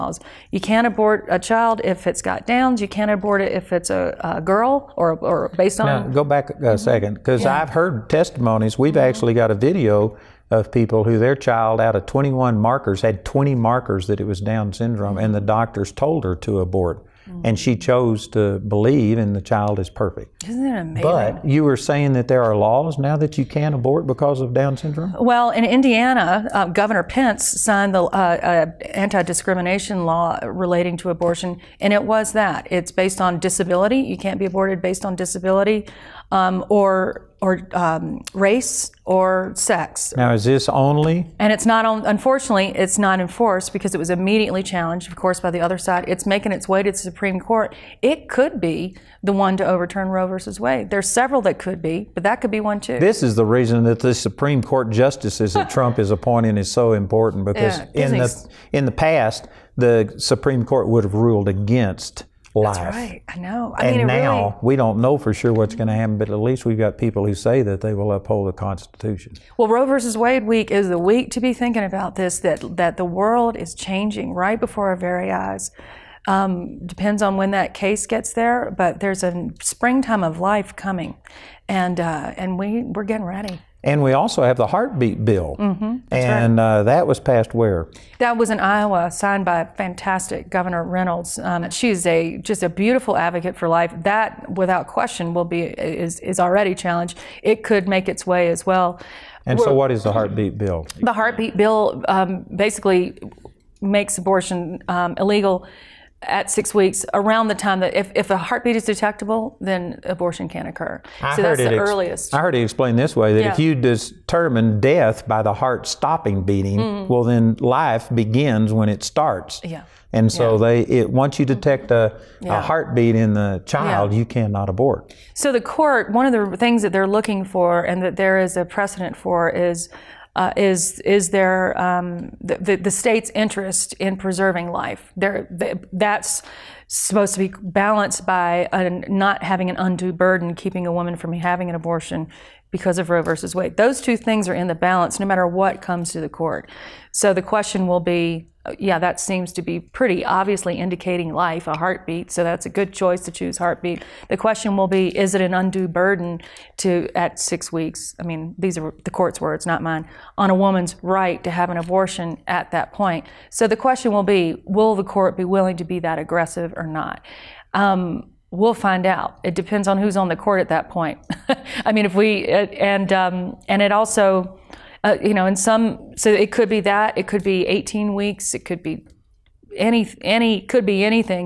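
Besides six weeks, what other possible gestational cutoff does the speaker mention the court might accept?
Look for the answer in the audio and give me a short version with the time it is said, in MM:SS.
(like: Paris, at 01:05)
18 weeks, at 02:57.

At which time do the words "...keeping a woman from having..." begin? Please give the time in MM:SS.
02:20.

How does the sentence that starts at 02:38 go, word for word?
I mean, these are the court's words, not mine, on a woman's right to have an abortion at that point.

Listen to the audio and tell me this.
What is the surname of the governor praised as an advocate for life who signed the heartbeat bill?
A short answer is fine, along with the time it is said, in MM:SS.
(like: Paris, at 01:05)
Reynolds, at 01:30.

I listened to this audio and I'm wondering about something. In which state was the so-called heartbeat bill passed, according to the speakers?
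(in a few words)
Iowa.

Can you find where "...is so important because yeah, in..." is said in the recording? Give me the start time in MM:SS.
00:56.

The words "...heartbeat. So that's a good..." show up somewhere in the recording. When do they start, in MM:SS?
02:31.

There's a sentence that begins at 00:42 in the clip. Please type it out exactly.
Unfortunately, it's not enforced because it was immediately challenged, of course, by the other side.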